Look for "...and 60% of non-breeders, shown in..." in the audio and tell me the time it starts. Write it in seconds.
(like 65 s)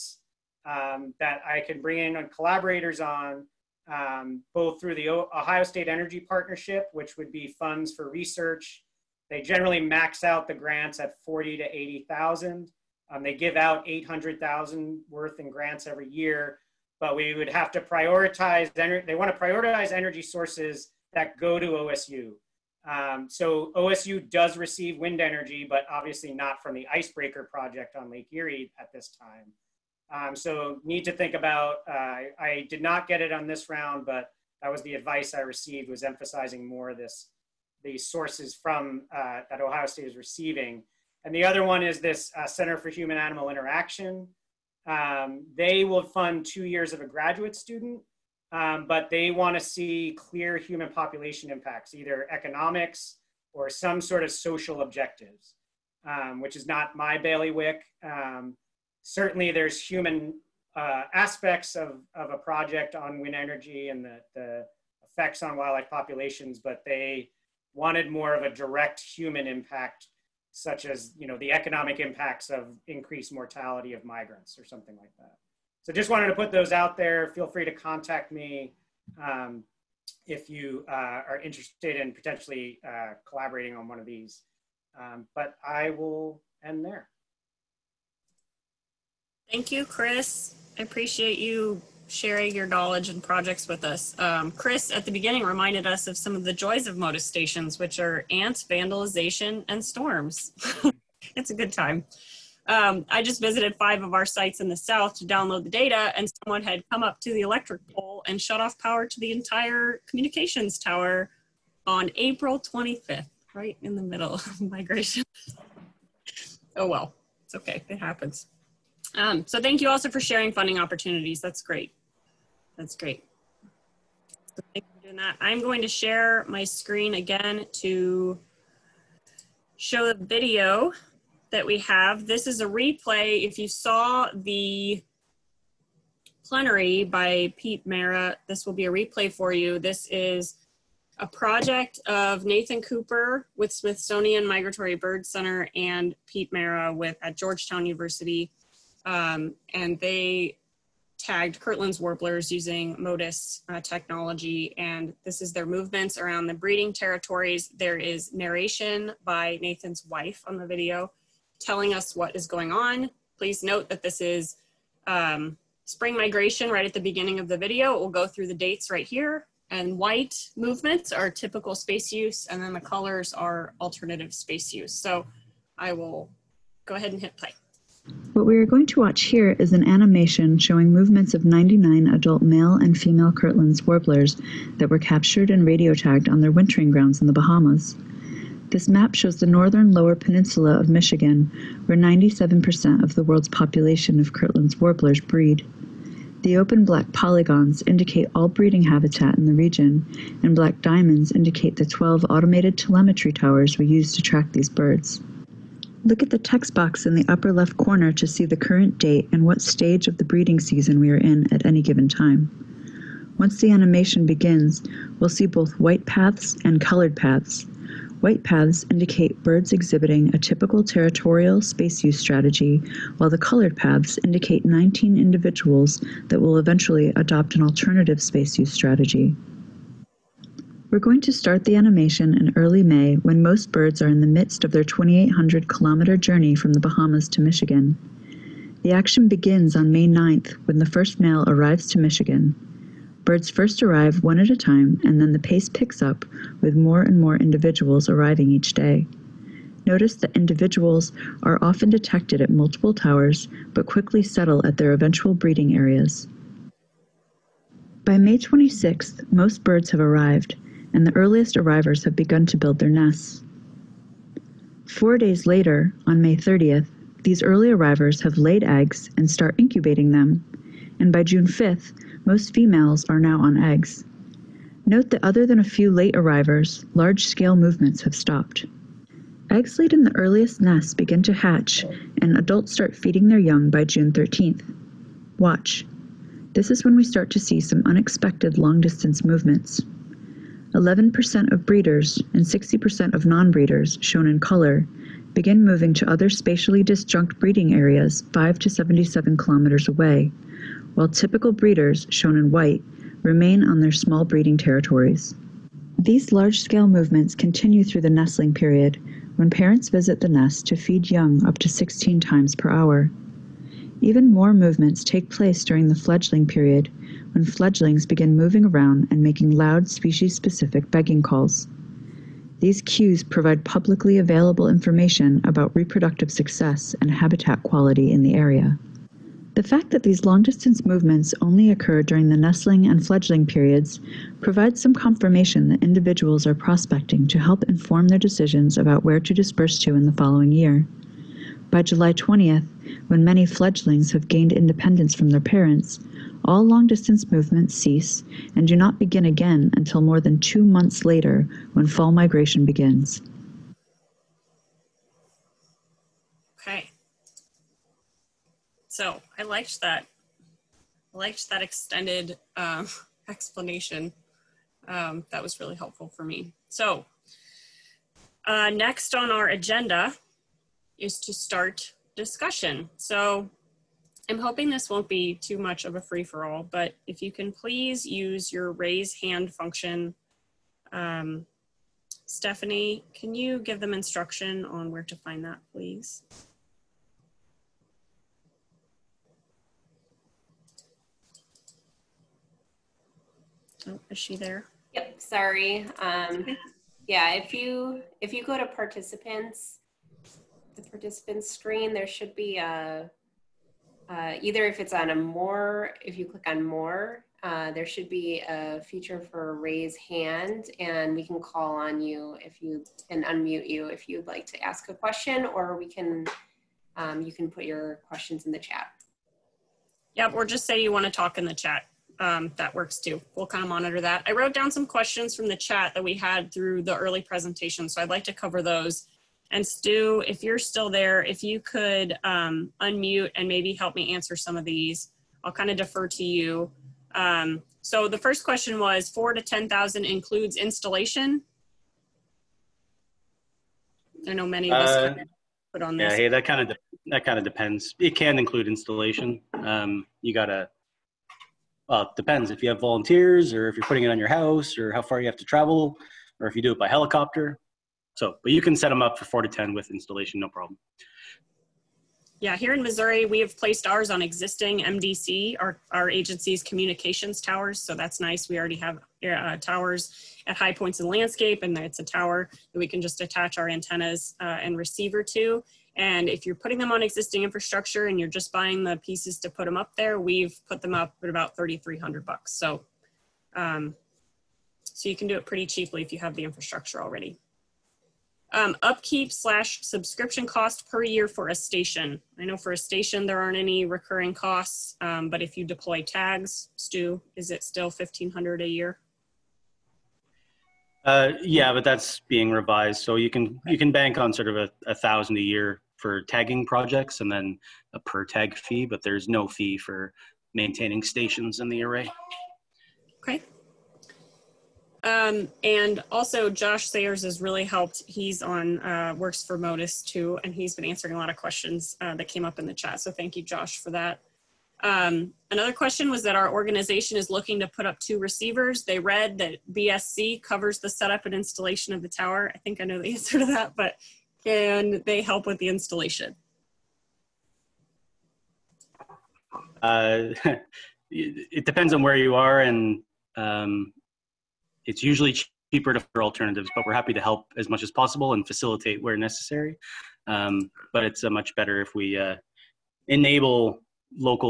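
292 s.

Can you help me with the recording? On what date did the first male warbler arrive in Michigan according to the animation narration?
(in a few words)
May 9.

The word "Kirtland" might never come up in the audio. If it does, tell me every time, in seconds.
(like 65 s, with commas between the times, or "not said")
151 s, 183 s, 194 s.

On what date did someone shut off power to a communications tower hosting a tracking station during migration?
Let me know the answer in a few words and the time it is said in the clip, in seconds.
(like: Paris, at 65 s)
April 25, at 112 s.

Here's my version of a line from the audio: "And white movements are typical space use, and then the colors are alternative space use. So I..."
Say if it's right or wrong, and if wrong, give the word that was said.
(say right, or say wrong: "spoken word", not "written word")
right.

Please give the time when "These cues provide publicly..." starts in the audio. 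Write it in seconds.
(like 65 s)
322 s.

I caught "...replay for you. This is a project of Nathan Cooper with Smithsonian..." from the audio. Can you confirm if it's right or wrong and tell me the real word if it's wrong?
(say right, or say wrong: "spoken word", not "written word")
right.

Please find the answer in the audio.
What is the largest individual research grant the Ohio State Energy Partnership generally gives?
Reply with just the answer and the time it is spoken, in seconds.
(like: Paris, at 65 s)
80,000, at 11 s.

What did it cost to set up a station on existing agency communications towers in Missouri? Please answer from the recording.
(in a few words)
$3,300.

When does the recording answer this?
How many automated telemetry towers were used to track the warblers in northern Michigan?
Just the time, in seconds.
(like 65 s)
201 s.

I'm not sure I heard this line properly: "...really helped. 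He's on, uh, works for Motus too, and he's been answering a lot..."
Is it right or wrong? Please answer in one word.
right.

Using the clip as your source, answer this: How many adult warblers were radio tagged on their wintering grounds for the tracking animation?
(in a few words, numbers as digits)
99.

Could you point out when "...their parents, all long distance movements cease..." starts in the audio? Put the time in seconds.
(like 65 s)
345 s.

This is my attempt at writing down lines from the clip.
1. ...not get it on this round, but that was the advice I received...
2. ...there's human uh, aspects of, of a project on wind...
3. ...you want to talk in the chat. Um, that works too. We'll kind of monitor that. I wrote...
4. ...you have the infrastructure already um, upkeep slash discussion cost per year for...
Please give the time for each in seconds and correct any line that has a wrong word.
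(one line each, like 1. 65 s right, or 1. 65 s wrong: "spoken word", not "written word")
1. 32 s right
2. 59 s right
3. 420 s right
4. 486 s wrong: "subscription", not "discussion".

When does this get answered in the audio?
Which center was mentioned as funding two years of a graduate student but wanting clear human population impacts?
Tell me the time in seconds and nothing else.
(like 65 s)
42 s.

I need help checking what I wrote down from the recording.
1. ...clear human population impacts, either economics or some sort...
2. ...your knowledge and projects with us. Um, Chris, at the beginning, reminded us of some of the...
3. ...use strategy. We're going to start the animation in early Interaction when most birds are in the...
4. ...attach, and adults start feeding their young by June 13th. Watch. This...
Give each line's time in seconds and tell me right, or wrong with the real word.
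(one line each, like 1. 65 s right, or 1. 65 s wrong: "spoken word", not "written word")
1. 50 s right
2. 92 s right
3. 228 s wrong: "May", not "Interaction"
4. 281 s wrong: "hatch", not "attach".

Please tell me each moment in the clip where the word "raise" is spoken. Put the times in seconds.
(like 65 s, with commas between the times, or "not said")
378 s, 409 s.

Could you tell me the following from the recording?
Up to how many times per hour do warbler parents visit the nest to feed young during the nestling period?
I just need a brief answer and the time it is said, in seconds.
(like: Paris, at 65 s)
16, at 311 s.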